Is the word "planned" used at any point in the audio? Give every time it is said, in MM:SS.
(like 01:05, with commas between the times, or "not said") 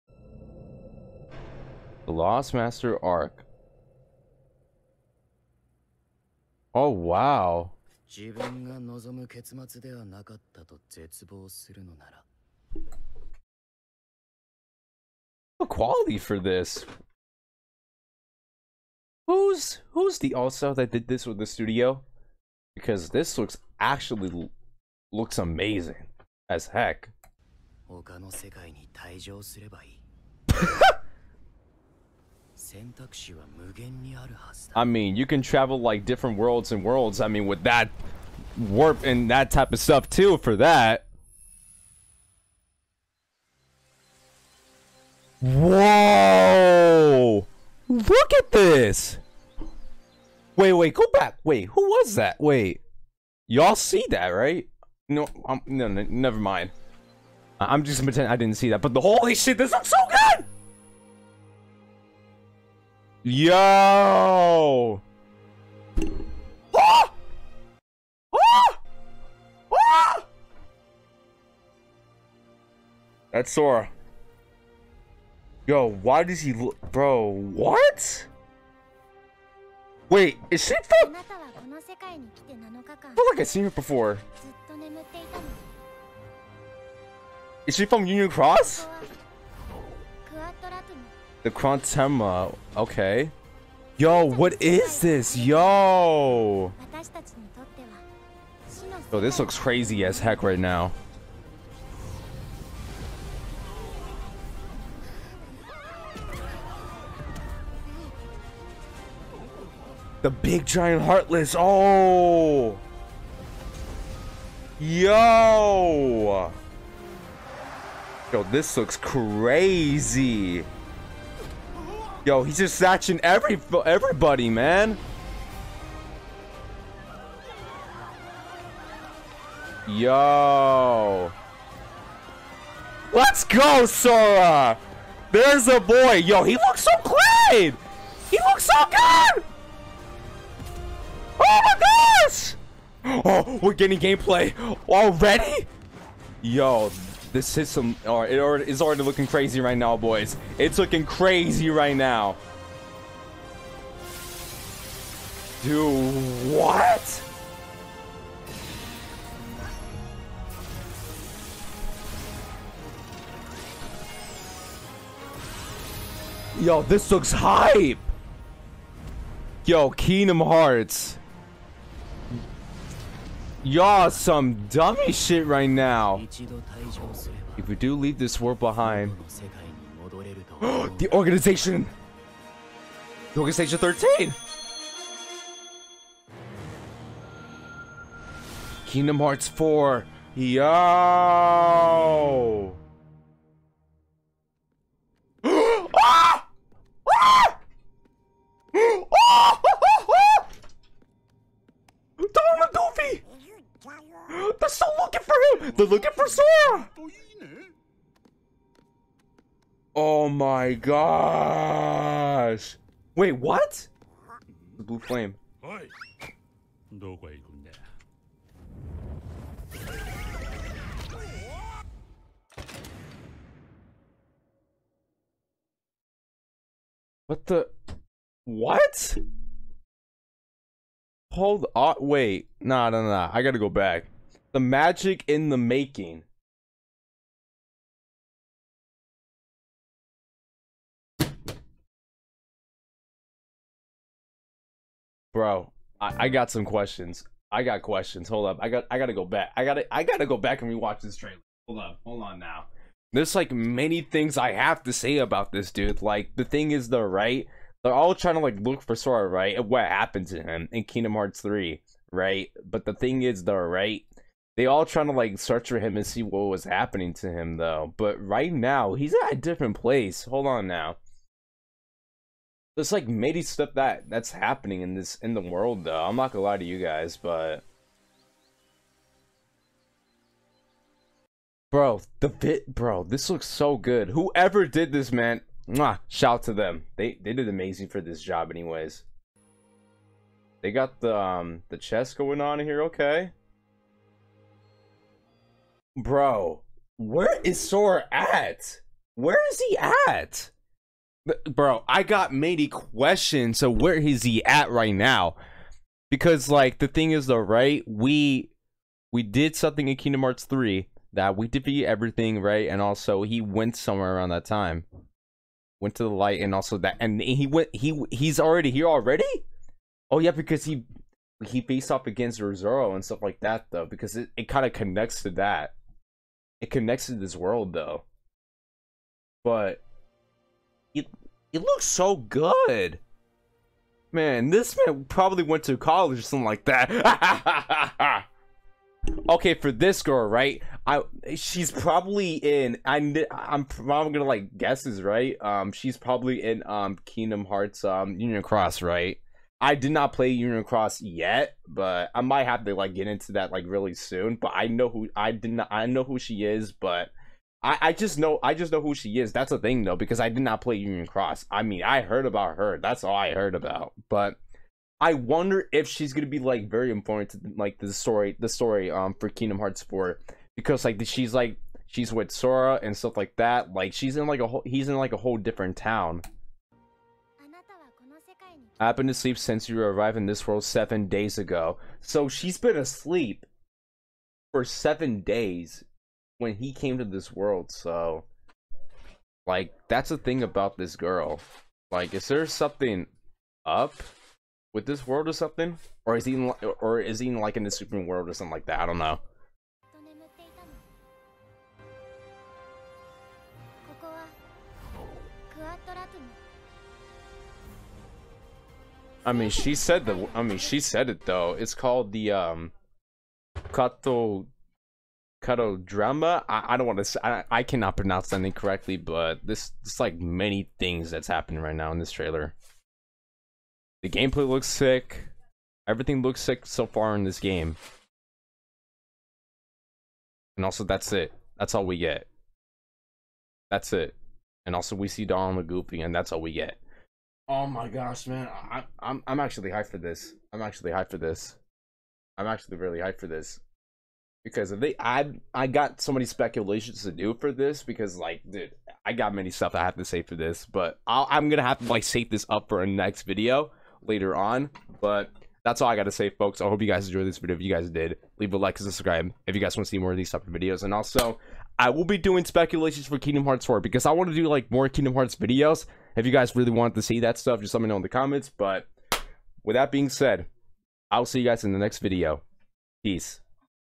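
not said.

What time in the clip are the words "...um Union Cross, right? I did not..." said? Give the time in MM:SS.
05:47.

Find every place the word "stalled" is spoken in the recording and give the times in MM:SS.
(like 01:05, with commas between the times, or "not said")
not said.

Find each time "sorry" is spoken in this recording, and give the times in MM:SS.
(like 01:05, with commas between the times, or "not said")
not said.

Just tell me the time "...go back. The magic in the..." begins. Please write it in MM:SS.
03:53.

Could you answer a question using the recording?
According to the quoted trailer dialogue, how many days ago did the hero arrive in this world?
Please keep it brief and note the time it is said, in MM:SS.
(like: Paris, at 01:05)
7, at 06:20.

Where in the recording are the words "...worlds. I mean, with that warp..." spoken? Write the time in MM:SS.
00:36.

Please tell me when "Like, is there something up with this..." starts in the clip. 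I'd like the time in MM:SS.
06:31.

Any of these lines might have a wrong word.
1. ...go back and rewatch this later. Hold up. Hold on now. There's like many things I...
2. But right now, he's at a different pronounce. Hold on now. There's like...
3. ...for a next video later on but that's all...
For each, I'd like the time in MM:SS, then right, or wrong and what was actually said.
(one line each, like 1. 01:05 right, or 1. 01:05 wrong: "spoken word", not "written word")
1. 04:10 wrong: "trailer", not "later"
2. 04:27 wrong: "place", not "pronounce"
3. 07:32 right.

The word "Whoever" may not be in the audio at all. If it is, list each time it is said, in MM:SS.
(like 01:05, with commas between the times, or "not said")
04:44.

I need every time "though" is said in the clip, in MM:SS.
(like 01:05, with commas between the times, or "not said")
04:27, 04:35, 05:07, 05:23, 05:27, 05:59, 06:51.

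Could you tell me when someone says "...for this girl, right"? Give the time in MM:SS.
05:39.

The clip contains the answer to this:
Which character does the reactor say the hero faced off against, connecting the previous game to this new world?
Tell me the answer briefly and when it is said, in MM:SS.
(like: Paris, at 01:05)
Yozora, at 05:22.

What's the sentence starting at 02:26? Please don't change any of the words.
Yo, this system or it already, is already looking crazy right now, boys.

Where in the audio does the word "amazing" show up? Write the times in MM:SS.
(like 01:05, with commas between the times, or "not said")
00:25, 04:47.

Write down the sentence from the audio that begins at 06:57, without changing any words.
I I cannot pronounce that incorrectly, but this it's like many things that's happening right now in this trailer.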